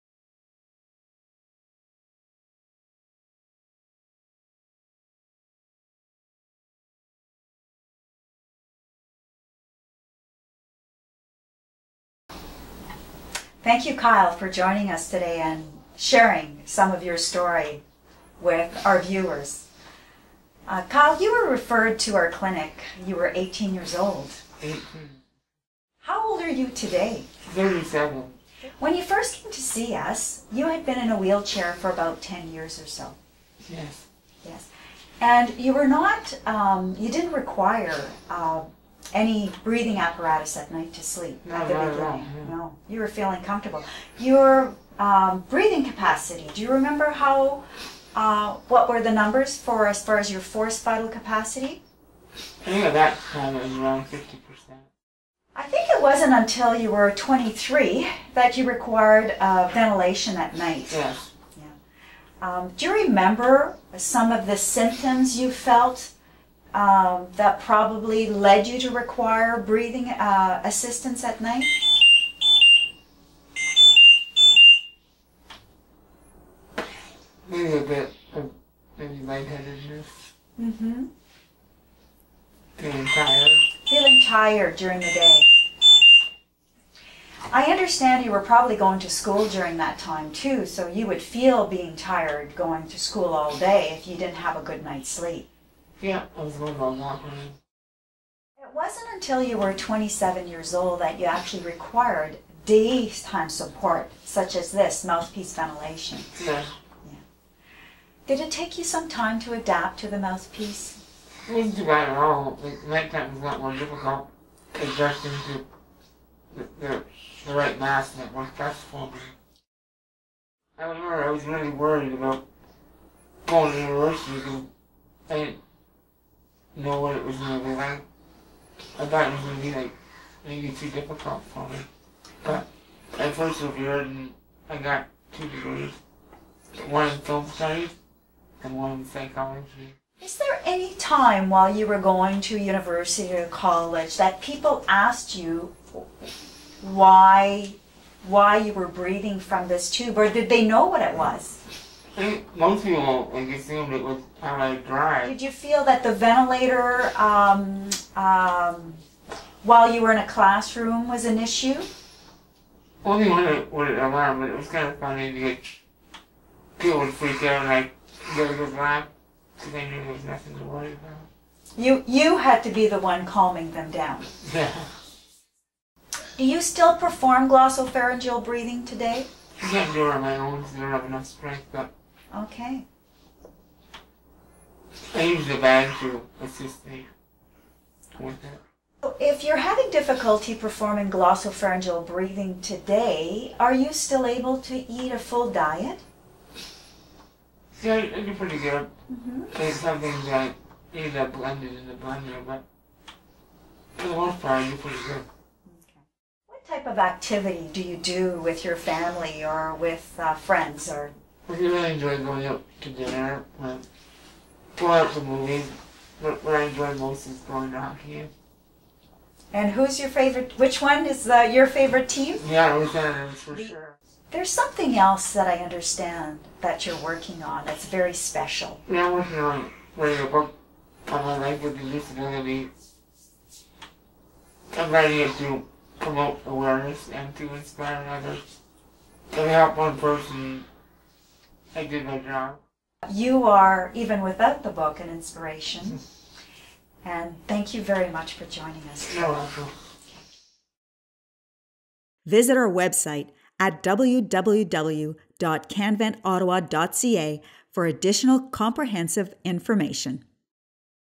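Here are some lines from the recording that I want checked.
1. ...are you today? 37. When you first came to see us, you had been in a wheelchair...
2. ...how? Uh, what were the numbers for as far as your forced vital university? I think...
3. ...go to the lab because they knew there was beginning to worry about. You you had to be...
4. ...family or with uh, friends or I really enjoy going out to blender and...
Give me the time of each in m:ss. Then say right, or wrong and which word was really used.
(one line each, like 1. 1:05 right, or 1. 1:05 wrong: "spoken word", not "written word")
1. 0:26 right
2. 0:47 wrong: "capacity", not "university"
3. 2:48 wrong: "nothing", not "beginning"
4. 3:28 wrong: "dinner", not "blender".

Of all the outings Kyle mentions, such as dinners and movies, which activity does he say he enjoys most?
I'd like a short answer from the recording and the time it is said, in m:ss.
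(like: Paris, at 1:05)
Hockey, at 3:37.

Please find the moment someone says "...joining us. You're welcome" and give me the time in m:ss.
4:08.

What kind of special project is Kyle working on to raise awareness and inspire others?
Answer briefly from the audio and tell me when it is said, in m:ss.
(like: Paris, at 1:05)
A book, at 3:50.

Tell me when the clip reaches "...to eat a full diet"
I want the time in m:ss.
3:14.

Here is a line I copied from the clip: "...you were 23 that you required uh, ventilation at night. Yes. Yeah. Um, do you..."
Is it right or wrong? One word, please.
right.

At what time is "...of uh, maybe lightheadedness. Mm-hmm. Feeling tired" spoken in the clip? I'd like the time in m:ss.
1:18.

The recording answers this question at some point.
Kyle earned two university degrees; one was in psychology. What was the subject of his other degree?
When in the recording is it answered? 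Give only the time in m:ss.
2:17.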